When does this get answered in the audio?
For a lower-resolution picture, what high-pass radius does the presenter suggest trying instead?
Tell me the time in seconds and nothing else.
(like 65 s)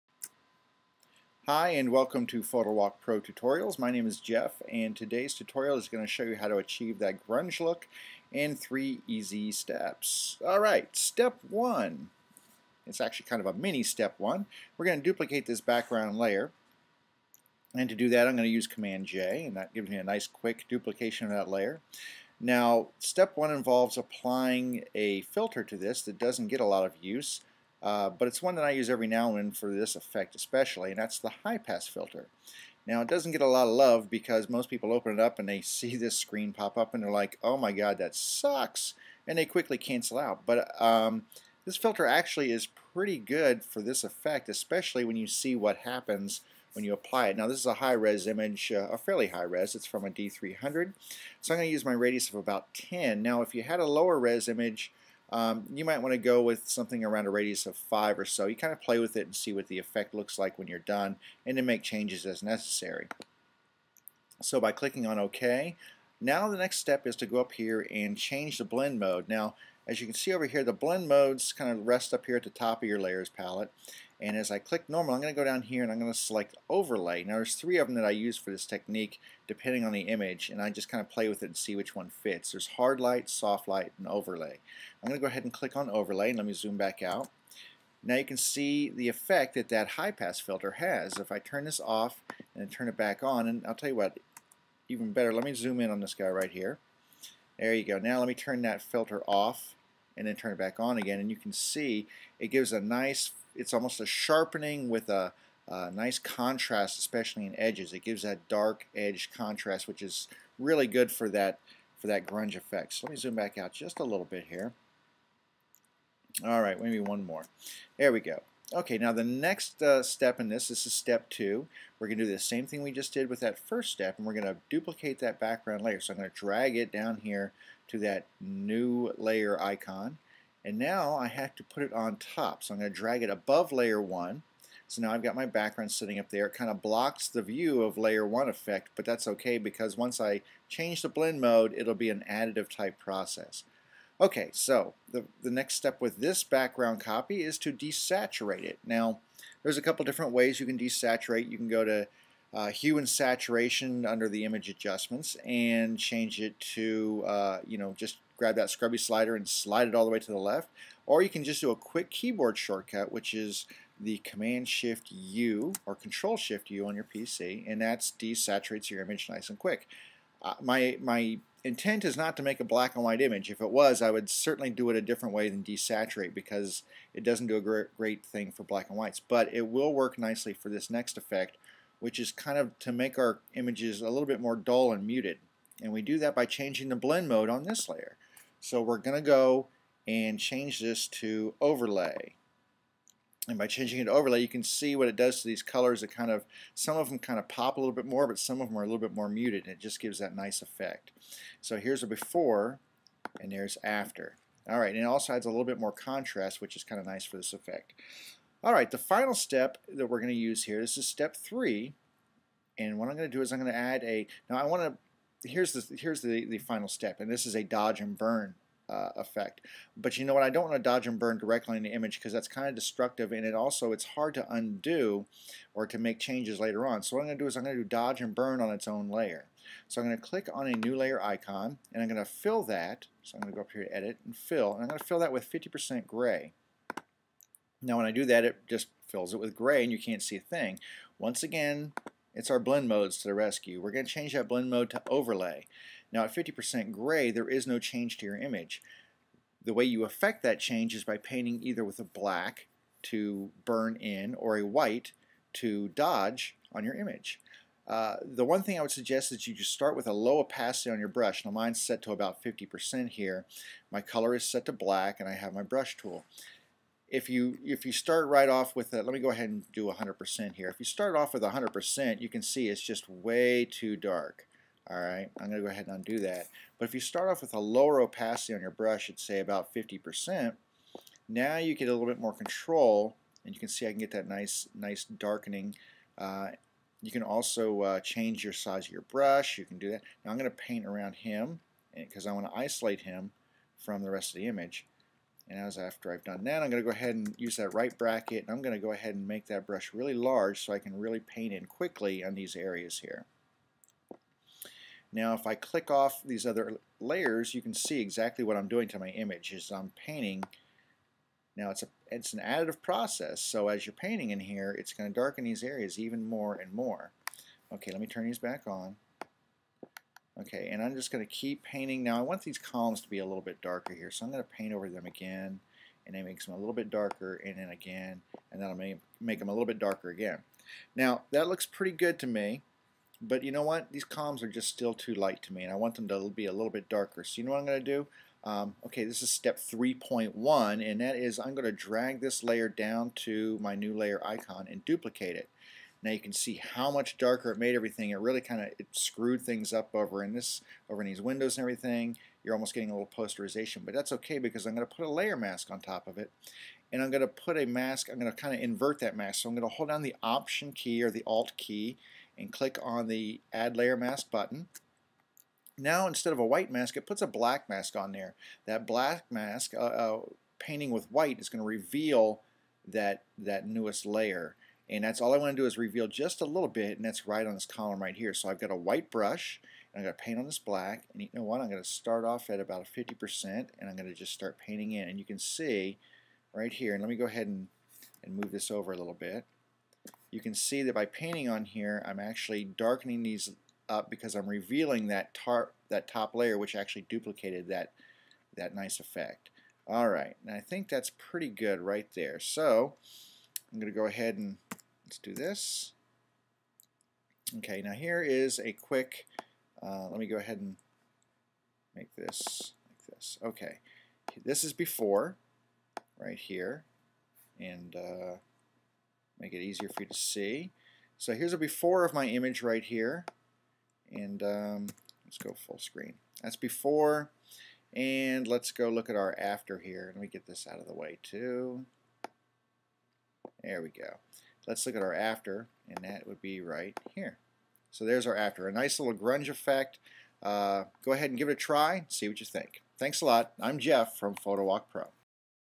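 57 s.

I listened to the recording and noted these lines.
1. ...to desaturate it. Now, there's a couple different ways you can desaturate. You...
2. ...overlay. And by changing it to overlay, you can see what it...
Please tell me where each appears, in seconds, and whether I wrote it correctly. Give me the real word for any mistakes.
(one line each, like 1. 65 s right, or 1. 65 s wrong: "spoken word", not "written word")
1. 147 s right
2. 191 s right.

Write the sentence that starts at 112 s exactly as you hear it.
So let me zoom back out just a little bit here.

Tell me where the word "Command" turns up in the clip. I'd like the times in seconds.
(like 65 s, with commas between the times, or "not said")
18 s, 164 s.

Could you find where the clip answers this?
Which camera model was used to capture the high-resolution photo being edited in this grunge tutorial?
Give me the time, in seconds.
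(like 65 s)
50 s.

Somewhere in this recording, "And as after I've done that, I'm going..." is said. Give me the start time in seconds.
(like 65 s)
295 s.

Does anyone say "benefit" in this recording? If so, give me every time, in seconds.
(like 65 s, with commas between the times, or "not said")
not said.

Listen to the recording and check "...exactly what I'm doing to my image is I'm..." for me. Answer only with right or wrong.
right.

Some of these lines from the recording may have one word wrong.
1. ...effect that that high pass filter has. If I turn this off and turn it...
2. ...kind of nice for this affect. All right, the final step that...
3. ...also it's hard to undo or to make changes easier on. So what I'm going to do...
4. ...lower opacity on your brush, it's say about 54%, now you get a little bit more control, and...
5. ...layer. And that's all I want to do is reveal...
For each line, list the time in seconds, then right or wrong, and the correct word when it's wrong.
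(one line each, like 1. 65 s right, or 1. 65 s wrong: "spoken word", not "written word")
1. 89 s right
2. 206 s wrong: "effect", not "affect"
3. 223 s wrong: "later", not "easier"
4. 277 s wrong: "50", not "54"
5. 374 s right.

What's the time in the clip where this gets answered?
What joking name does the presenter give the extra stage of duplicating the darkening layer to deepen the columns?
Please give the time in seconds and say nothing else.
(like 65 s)
339 s.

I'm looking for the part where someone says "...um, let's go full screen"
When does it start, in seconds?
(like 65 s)
424 s.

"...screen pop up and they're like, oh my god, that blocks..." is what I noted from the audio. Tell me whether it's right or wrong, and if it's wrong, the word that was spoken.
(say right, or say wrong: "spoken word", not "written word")
wrong: "sucks", not "blocks".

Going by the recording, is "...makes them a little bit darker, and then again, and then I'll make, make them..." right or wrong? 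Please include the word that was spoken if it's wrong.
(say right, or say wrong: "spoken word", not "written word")
right.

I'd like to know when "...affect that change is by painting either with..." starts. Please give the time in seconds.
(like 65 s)
250 s.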